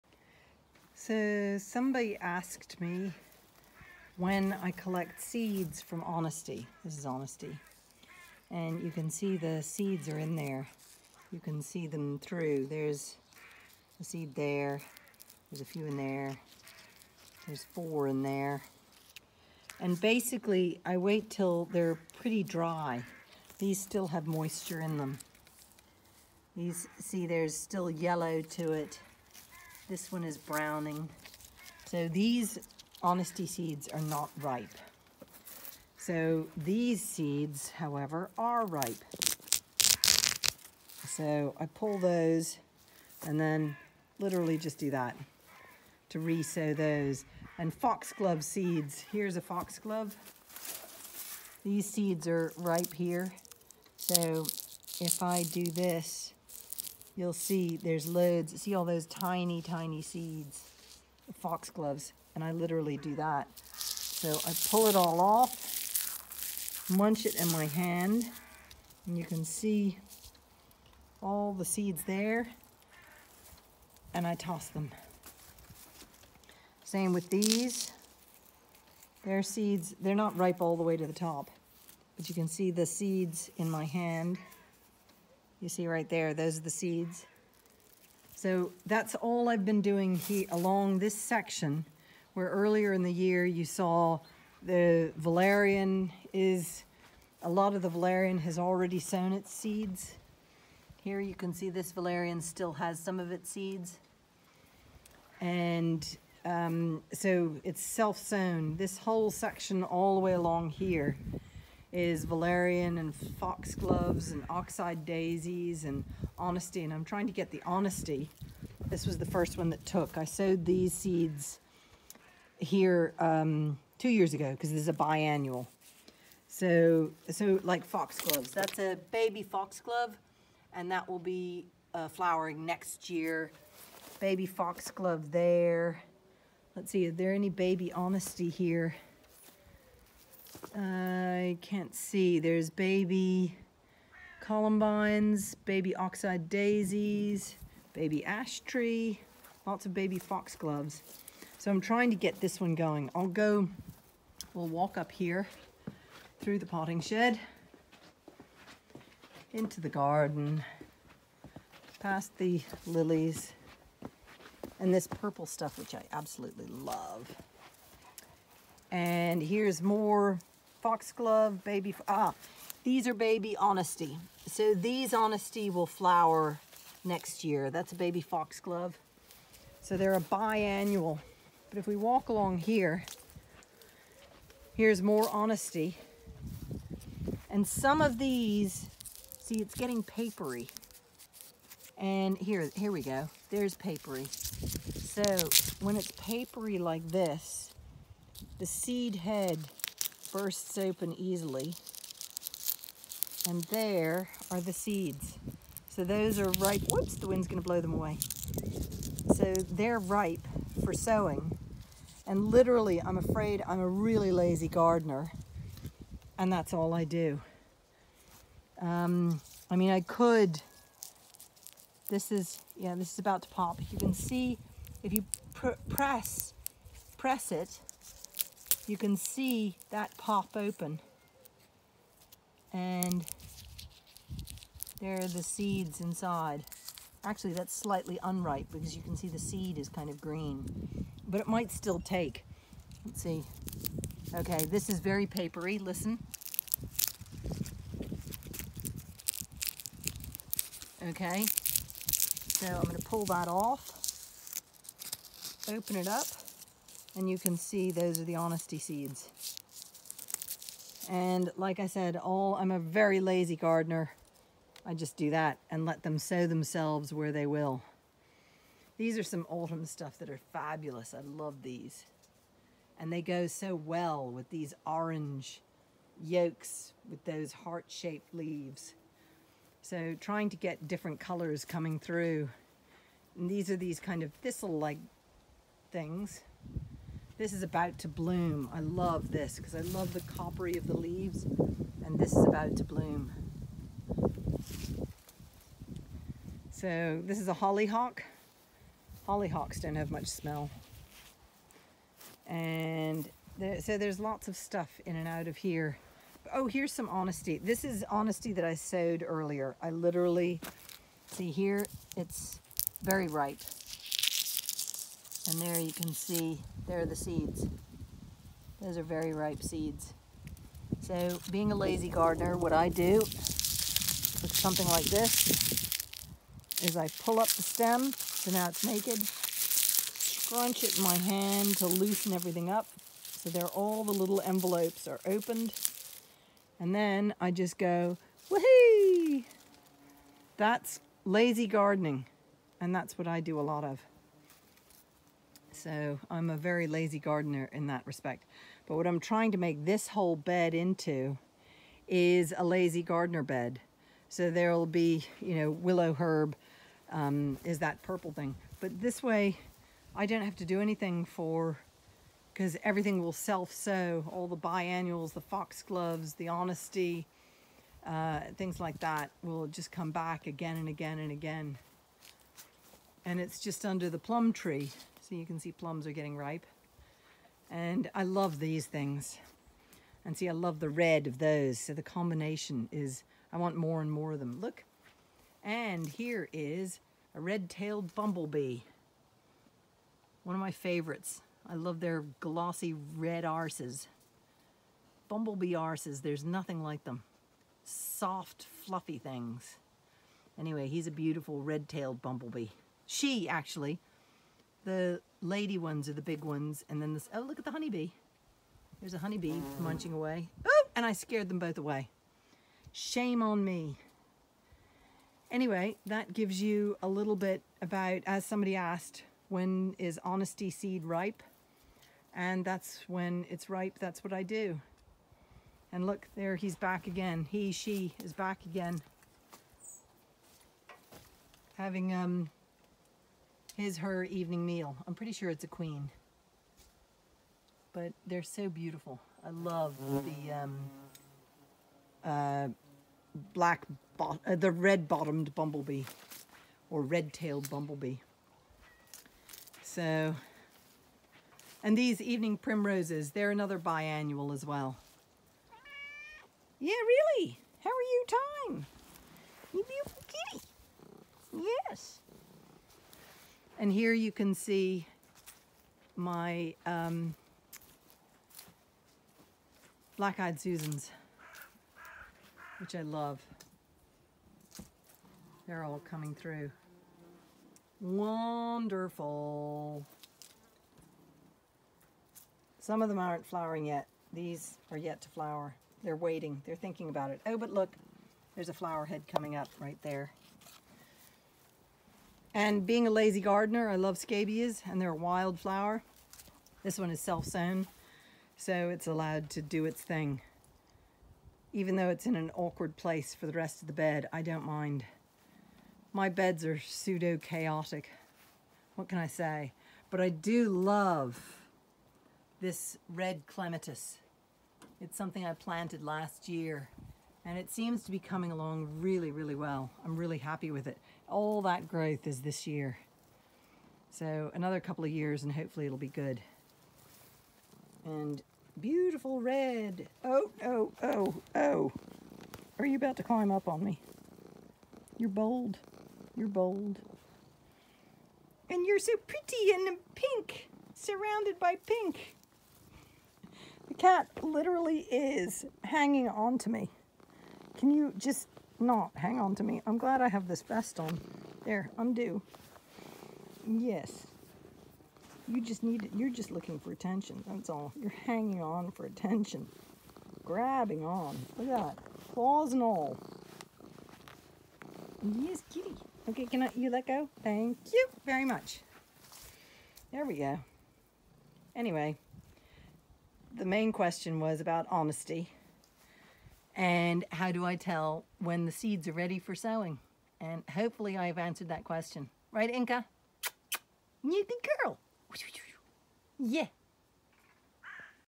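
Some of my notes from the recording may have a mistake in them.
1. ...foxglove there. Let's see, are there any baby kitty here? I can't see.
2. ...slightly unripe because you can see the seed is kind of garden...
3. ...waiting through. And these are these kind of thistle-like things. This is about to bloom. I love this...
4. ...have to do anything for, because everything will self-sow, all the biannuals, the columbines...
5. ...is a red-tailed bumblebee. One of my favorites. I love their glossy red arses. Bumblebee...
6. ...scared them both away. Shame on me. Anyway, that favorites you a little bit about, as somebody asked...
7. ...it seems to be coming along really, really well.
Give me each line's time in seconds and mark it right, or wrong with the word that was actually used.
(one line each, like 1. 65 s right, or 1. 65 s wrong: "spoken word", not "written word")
1. 134 s wrong: "honesty", not "kitty"
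2. 237 s wrong: "green", not "garden"
3. 281 s wrong: "coming", not "waiting"
4. 360 s wrong: "foxgloves", not "columbines"
5. 386 s right
6. 411 s wrong: "gives", not "favorites"
7. 517 s right.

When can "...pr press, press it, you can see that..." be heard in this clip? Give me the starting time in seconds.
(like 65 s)
225 s.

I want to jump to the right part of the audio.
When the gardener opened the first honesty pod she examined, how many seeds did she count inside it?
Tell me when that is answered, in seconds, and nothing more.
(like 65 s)
17 s.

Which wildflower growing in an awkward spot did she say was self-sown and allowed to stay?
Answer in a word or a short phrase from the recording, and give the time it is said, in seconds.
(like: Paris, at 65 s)
Scabious, at 494 s.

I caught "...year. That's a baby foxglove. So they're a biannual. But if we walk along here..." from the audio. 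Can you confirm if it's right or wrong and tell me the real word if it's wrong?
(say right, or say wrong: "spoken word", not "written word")
right.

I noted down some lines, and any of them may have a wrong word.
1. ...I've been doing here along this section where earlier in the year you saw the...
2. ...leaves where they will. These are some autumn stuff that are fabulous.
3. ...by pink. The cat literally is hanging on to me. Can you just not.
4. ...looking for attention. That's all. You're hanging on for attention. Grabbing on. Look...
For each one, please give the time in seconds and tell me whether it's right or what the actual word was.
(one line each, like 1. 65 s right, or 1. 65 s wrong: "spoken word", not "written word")
1. 89 s right
2. 266 s wrong: "themselves", not "leaves"
3. 541 s right
4. 556 s right.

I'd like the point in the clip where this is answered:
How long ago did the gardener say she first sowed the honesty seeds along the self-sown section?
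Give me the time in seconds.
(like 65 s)
123 s.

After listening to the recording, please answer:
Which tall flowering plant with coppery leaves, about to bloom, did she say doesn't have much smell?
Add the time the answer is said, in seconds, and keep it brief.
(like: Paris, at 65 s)
Hollyhock, at 297 s.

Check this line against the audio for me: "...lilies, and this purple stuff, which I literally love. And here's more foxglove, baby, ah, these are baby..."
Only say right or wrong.
wrong.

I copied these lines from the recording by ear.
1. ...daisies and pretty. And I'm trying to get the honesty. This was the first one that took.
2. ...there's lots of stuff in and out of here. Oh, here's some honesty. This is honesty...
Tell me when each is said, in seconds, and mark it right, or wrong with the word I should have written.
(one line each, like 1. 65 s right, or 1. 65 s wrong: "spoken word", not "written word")
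1. 114 s wrong: "honesty", not "pretty"
2. 303 s right.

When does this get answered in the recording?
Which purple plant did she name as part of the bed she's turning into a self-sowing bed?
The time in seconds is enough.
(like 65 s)
355 s.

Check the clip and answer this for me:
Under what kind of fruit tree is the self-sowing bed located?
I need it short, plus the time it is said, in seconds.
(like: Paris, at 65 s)
Plum tree, at 374 s.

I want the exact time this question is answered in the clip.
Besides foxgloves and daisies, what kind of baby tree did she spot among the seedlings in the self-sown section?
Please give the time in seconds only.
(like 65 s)
147 s.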